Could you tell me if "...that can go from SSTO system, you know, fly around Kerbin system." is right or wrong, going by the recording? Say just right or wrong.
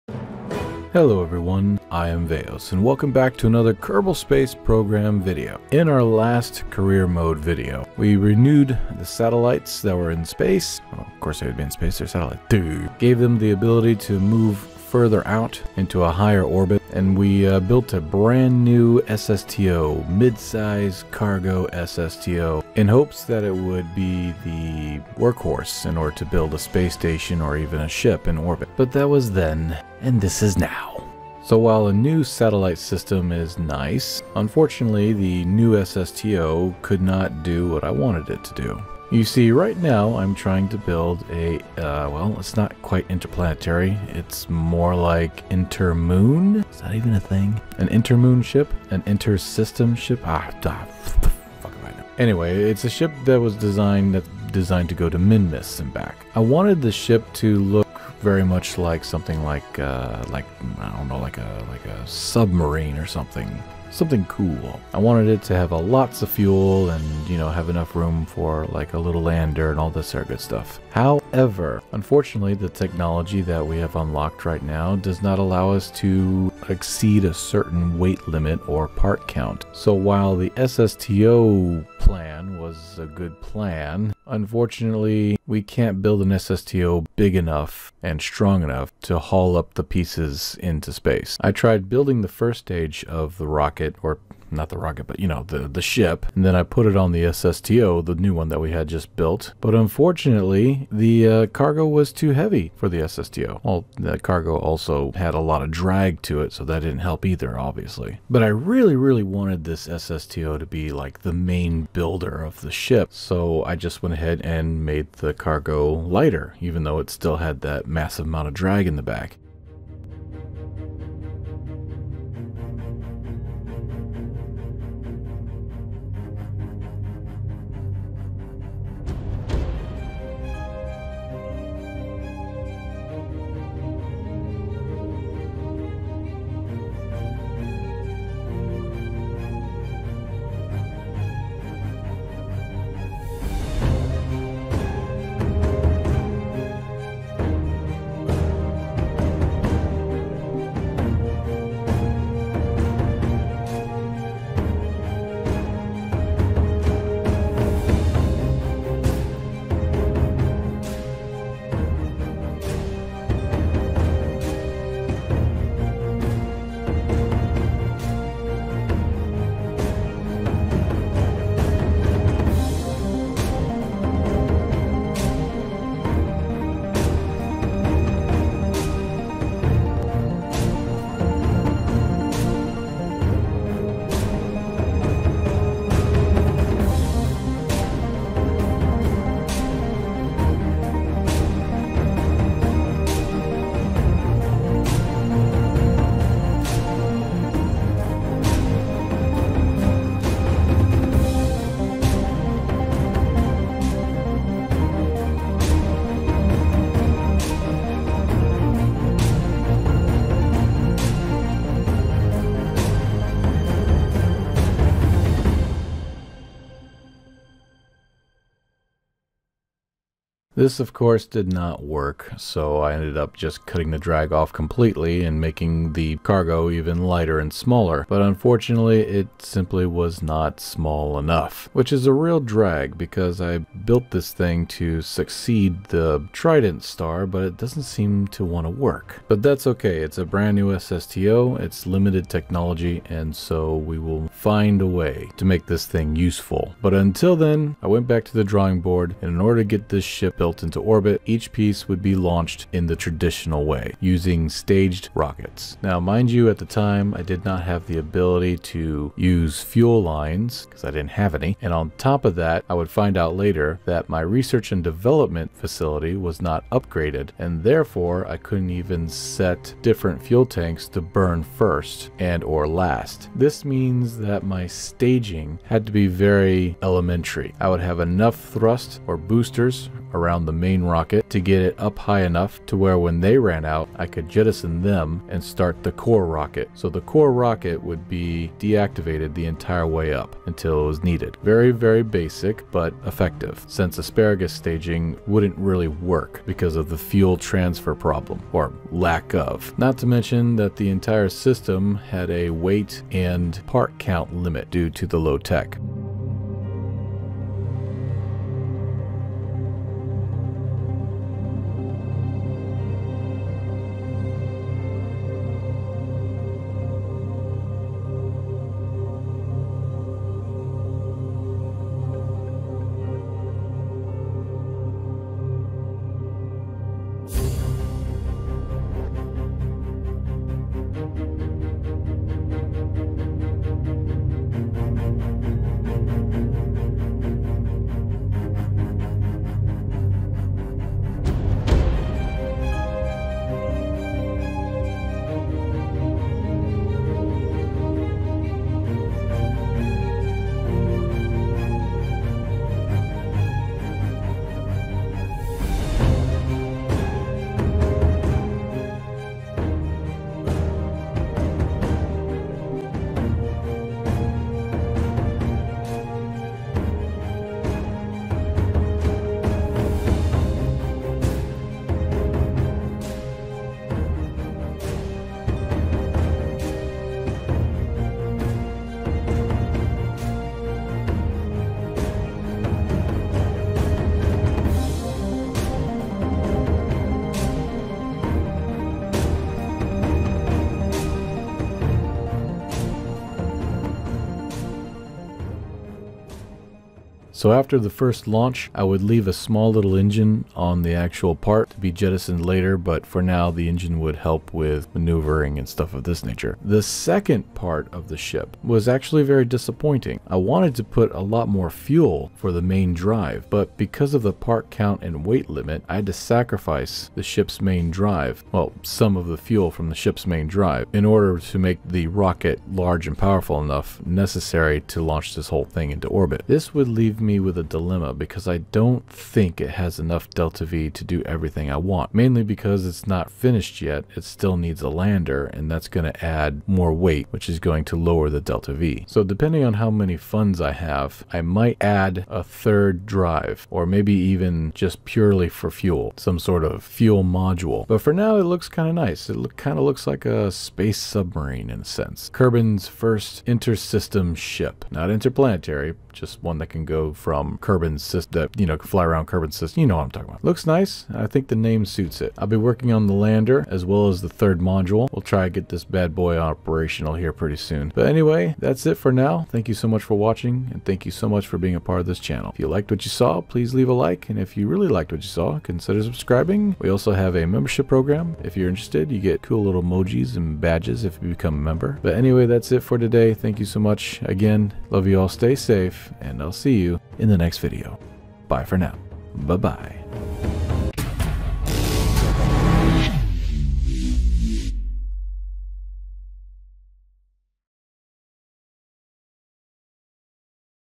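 wrong.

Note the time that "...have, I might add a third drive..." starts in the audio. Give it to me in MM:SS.
07:20.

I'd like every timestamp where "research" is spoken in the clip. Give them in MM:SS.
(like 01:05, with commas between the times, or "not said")
04:24.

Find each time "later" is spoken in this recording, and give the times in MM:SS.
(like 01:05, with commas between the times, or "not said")
04:23, 06:42.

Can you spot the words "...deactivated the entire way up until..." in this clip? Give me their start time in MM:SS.
04:48.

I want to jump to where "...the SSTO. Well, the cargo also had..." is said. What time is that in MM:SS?
01:42.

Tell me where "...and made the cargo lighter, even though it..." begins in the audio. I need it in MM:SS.
01:54.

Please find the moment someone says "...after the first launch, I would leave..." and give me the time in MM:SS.
06:37.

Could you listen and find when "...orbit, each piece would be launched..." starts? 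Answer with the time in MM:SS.
04:10.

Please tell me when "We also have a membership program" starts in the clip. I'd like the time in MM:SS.
07:56.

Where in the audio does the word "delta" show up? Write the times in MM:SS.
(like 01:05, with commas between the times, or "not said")
07:10, 07:18.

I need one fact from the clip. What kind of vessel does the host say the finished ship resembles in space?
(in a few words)
space submarine.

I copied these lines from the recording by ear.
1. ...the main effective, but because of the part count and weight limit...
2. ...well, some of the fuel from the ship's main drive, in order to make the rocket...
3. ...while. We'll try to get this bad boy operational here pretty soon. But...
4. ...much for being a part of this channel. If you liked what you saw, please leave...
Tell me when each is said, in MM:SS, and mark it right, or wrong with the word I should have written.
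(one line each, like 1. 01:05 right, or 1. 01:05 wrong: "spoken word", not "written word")
1. 06:52 wrong: "drive", not "effective"
2. 06:58 right
3. 07:44 wrong: "module", not "while"
4. 07:51 right.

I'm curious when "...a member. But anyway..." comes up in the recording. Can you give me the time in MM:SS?
08:01.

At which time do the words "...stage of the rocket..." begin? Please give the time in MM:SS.
01:32.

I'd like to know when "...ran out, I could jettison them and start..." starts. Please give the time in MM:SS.
04:43.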